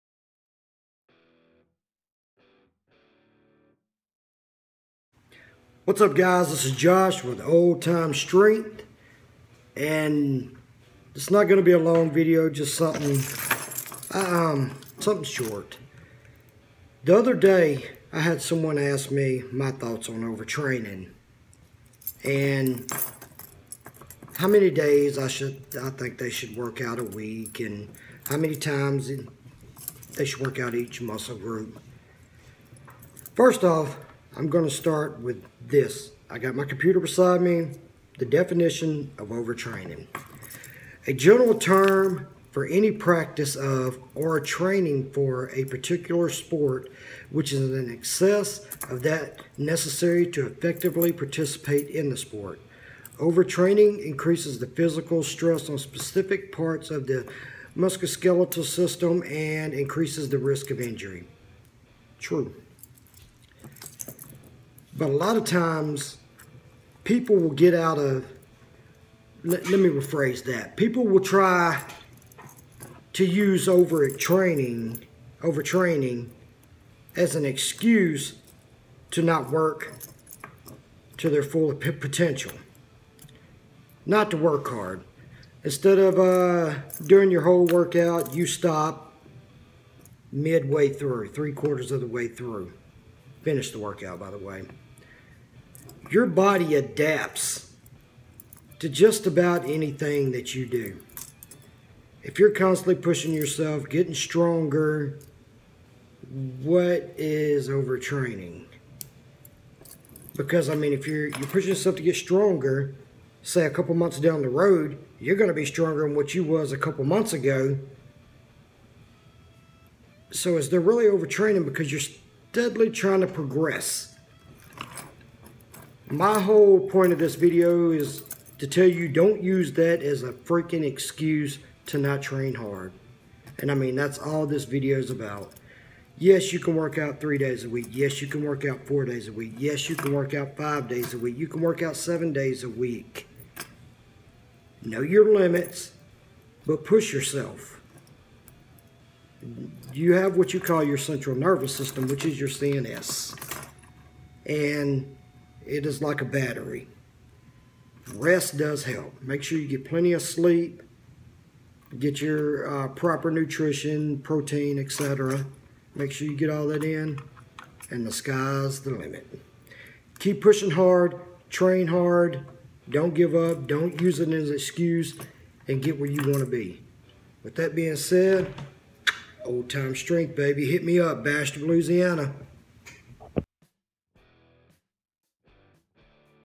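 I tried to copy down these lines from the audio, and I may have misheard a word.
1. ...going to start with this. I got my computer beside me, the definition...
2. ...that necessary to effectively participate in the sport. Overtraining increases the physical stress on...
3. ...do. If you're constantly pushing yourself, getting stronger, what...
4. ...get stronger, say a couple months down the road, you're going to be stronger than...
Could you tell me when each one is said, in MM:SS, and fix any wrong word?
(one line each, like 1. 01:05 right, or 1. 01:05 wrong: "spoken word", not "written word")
1. 00:34 right
2. 00:49 right
3. 01:40 right
4. 01:52 right.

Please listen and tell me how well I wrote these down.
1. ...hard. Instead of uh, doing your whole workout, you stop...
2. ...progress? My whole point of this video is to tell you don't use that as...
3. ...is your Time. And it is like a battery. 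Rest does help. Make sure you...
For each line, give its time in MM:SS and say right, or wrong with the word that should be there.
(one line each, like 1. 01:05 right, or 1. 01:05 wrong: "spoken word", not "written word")
1. 01:24 right
2. 02:03 right
3. 02:32 wrong: "CNS", not "Time".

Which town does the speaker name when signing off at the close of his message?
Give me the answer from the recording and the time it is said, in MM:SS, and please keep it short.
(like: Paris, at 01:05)
Bastrop, Louisiana, at 03:01.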